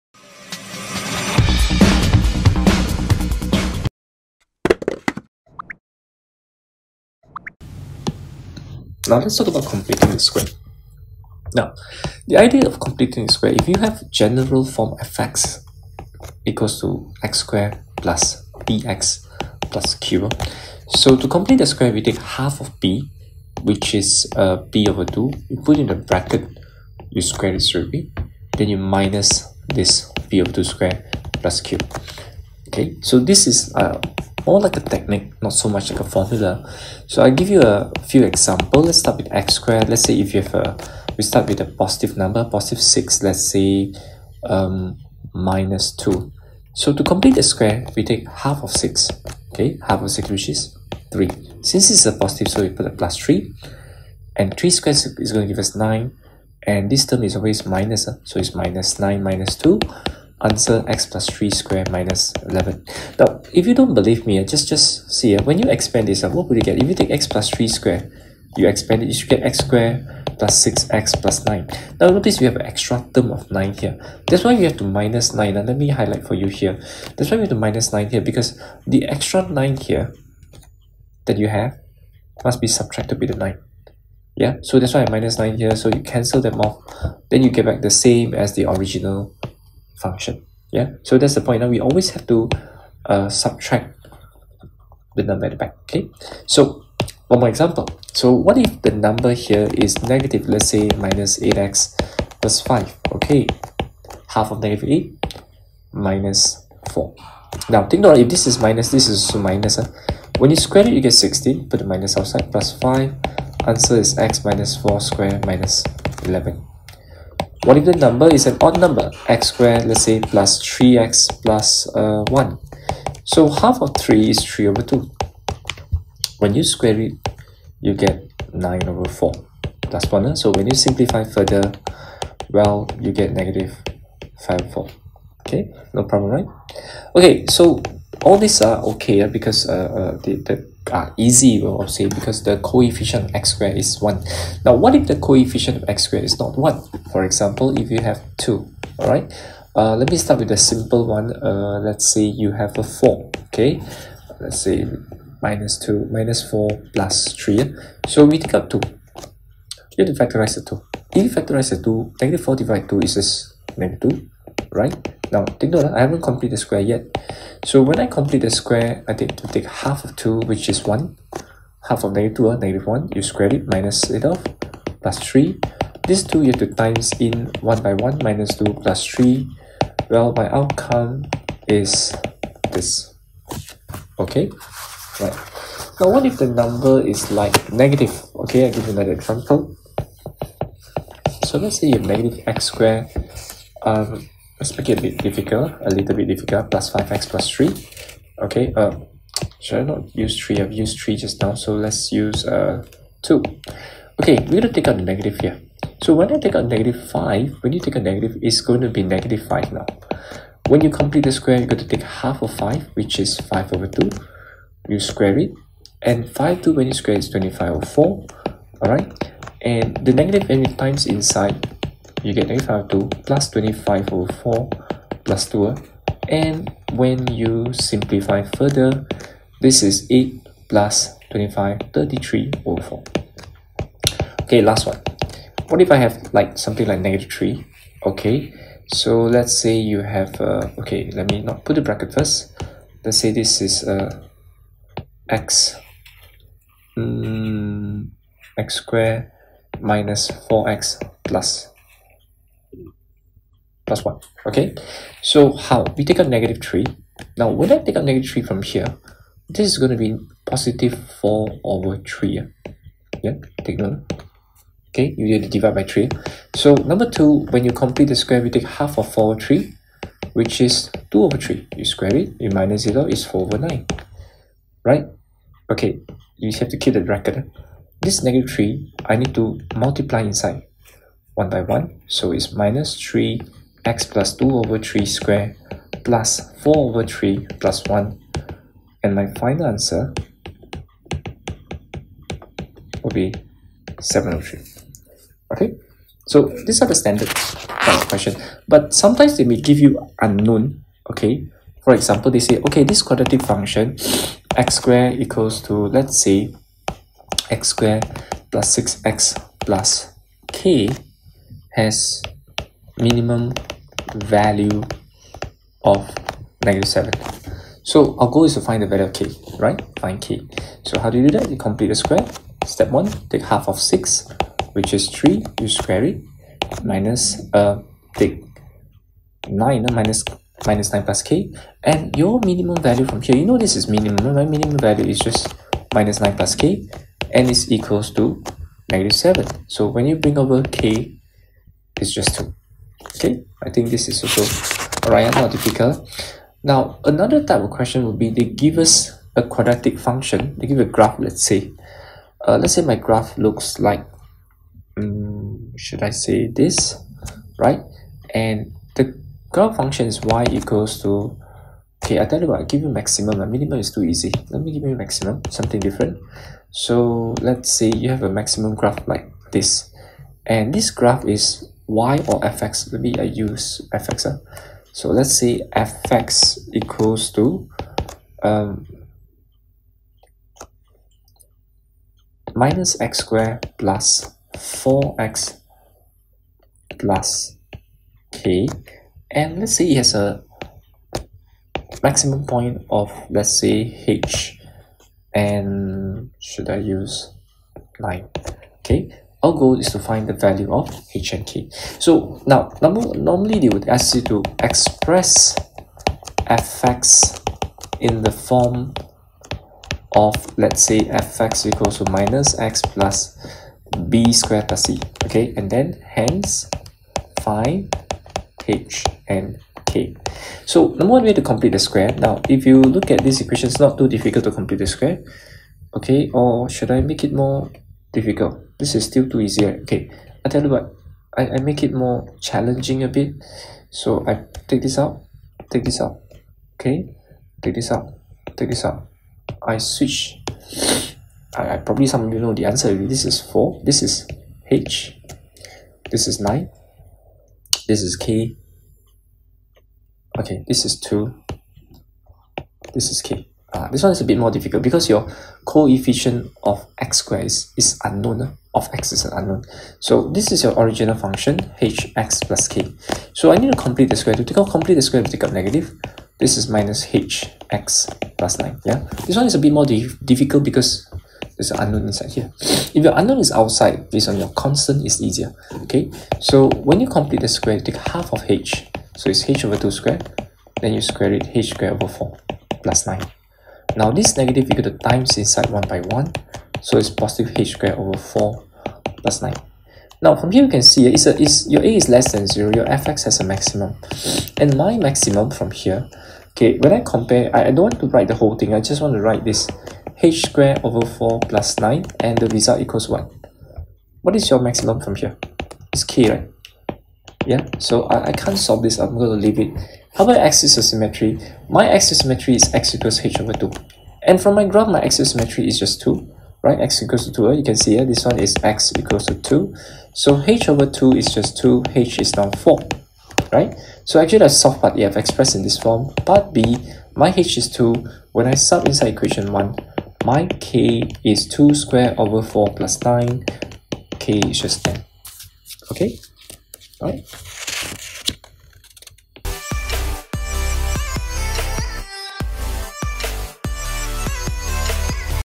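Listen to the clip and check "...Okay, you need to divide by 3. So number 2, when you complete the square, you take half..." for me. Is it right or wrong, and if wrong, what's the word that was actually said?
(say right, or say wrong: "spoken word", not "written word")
right.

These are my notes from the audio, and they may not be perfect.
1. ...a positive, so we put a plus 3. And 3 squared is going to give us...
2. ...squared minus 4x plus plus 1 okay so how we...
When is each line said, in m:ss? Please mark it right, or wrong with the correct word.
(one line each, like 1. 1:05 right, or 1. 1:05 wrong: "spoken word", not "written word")
1. 0:52 right
2. 4:08 right.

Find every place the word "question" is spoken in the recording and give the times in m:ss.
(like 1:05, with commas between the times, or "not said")
4:58, 5:47.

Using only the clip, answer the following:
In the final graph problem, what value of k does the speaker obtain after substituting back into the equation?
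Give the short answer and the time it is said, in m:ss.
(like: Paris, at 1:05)
10, at 8:54.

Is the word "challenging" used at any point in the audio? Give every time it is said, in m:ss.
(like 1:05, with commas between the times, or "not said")
7:12.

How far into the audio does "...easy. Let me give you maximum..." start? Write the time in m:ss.
6:04.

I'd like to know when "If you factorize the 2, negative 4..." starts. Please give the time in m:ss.
2:41.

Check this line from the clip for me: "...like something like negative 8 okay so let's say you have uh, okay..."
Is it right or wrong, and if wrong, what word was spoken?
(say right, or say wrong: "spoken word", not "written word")
wrong: "3", not "8".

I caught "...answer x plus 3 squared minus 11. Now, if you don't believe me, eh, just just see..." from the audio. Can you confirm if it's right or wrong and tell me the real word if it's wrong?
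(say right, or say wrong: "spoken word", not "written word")
right.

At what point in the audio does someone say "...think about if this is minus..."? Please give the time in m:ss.
1:47.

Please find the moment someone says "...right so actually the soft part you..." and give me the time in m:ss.
8:43.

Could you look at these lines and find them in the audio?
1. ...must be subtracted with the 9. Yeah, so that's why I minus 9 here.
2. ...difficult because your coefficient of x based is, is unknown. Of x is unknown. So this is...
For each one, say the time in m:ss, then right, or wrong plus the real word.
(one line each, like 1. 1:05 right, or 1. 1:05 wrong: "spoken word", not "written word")
1. 1:22 right
2. 7:34 wrong: "squared", not "based".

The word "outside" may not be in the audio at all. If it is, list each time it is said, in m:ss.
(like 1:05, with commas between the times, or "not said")
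1:52, 7:53.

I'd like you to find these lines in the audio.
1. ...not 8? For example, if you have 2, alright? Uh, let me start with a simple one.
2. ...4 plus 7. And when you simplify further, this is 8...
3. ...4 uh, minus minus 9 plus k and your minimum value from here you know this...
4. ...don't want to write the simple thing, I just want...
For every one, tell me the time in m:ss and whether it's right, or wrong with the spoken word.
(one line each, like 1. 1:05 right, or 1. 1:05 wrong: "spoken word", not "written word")
1. 2:26 wrong: "1", not "8"
2. 3:44 wrong: "2", not "7"
3. 5:29 wrong: "9", not "4"
4. 8:17 wrong: "whole", not "simple".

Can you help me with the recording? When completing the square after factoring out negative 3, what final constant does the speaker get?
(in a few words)
7/3.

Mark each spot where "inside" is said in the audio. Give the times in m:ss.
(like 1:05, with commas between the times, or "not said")
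3:41, 4:40, 7:52, 8:05, 8:48.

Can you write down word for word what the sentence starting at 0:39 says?
Let's say if you have a, we start with a positive number, positive 6, let's say um, minus 2.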